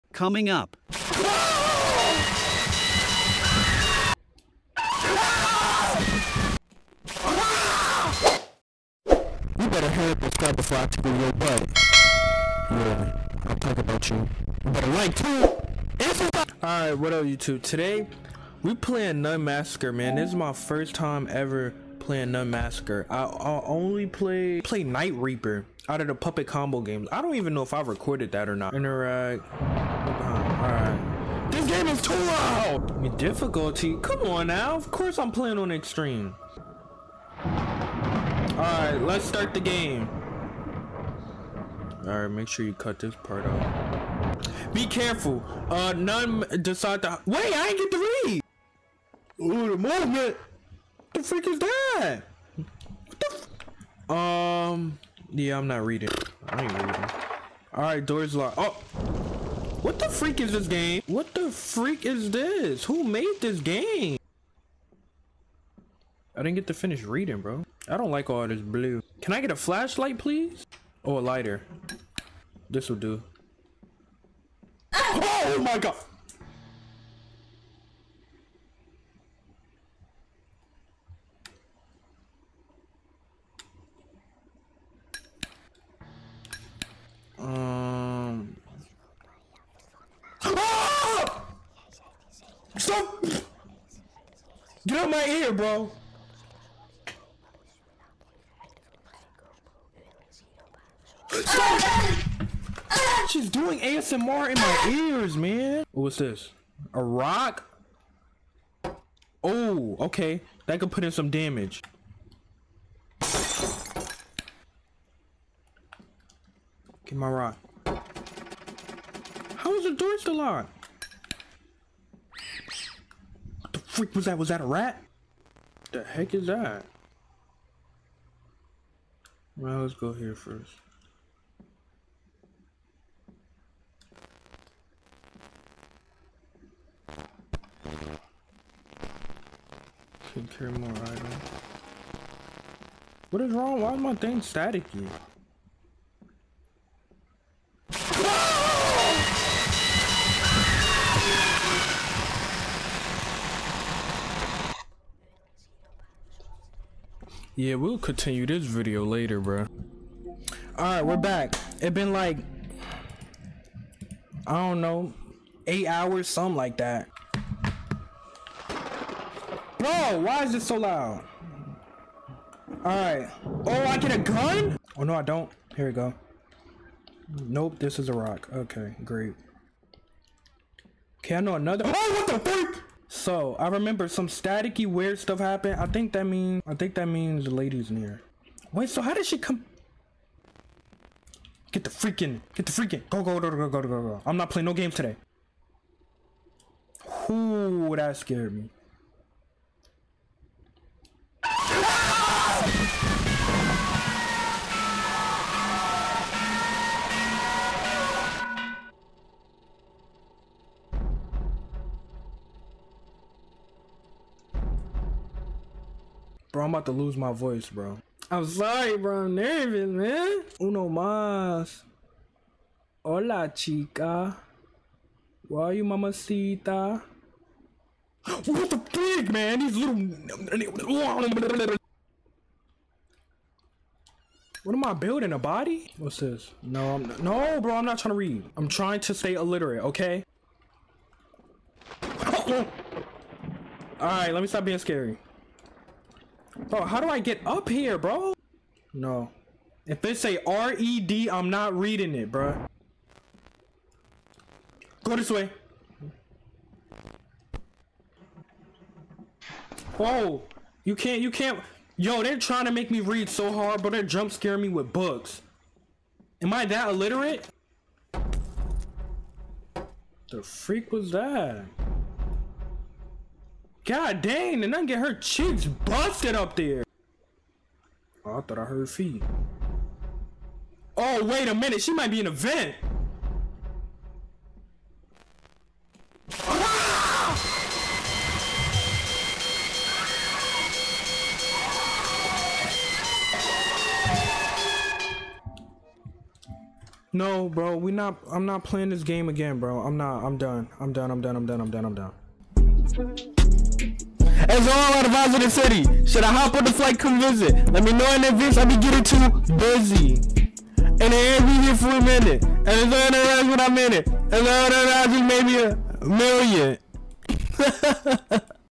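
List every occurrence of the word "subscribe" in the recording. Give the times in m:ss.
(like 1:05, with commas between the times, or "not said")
0:10.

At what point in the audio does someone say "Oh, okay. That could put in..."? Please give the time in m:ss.
1:49.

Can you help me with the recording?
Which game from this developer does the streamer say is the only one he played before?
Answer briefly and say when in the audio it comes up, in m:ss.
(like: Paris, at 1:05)
Night Reaper, at 0:24.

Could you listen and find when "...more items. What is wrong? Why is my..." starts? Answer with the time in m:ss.
2:20.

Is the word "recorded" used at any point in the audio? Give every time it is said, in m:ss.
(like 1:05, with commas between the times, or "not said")
0:27.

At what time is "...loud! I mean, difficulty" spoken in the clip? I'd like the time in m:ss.
0:32.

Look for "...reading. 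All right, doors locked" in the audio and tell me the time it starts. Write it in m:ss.
0:56.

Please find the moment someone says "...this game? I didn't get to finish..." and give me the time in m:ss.
1:03.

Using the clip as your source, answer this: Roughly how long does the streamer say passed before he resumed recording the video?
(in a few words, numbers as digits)
8 hours.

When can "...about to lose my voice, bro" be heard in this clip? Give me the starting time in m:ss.
3:36.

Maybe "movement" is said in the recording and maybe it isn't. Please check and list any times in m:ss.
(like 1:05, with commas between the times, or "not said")
0:49.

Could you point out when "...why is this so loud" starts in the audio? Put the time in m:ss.
2:50.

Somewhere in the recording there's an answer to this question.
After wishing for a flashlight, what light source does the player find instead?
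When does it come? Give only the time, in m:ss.
1:11.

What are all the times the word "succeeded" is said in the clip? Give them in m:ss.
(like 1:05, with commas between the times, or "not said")
not said.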